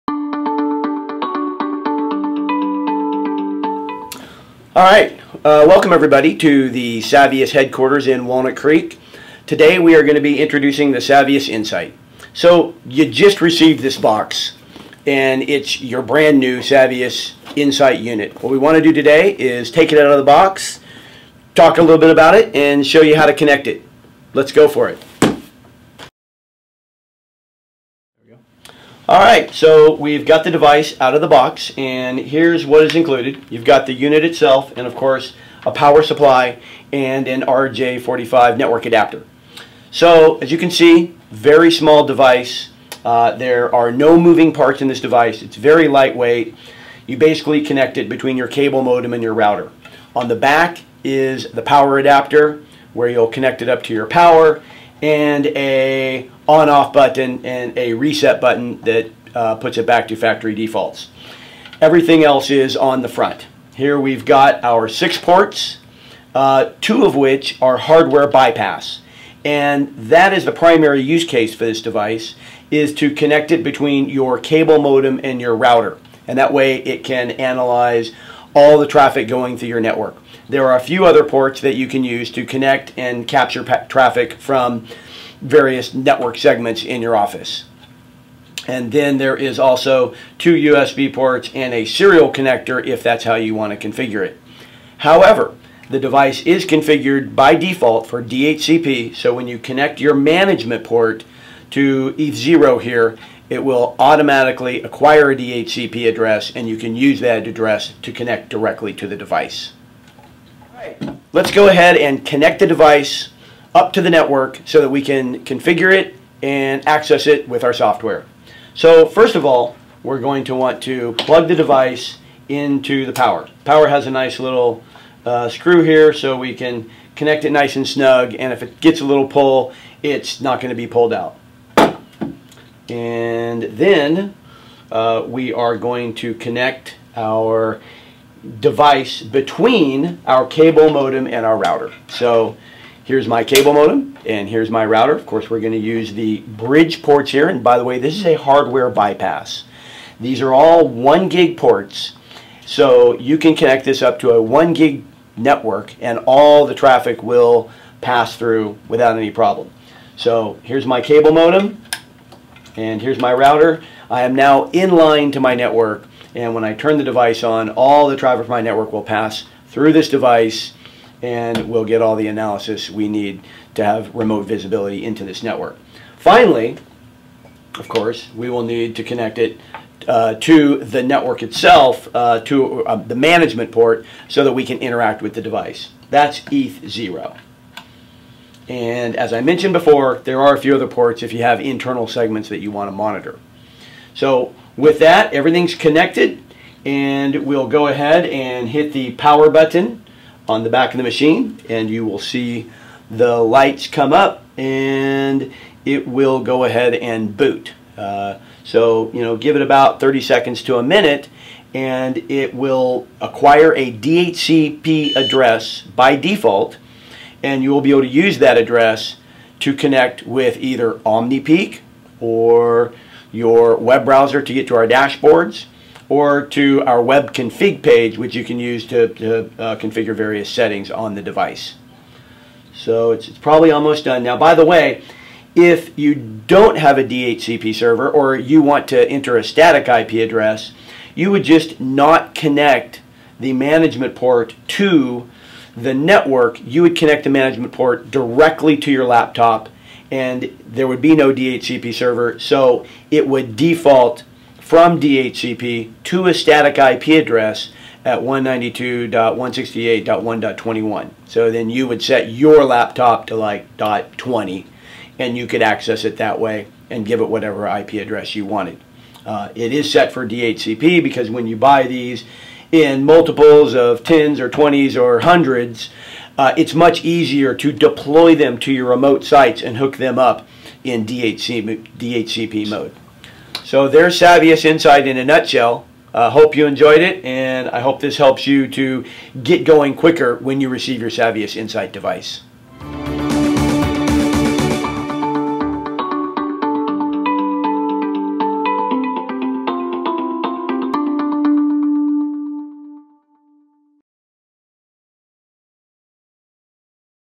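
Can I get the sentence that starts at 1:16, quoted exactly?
And that way it can analyze all the traffic going through your network.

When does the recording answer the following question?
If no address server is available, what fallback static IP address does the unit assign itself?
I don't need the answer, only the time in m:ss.
4:18.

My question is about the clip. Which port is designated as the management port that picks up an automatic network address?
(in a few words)
ETH0.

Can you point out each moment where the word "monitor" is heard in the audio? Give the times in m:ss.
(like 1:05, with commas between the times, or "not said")
3:12.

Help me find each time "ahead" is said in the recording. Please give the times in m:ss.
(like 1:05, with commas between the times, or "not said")
1:51, 3:17, 3:26.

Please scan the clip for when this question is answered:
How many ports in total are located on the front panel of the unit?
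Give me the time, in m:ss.
1:04.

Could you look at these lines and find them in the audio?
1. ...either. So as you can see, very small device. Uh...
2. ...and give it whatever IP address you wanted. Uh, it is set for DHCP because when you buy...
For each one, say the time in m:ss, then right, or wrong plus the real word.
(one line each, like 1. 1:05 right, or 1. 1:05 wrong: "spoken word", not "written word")
1. 0:38 wrong: "adapter", not "either"
2. 4:26 right.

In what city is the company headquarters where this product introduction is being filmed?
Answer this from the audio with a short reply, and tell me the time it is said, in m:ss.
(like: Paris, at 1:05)
Walnut Creek, at 0:08.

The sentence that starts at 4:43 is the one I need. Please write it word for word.
So there's Savvius Insight in a nutshell.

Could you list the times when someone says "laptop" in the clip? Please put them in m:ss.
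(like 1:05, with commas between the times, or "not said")
4:09, 4:22.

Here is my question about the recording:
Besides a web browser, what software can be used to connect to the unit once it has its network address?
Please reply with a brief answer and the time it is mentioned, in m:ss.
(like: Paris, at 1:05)
OmniPeak, at 3:40.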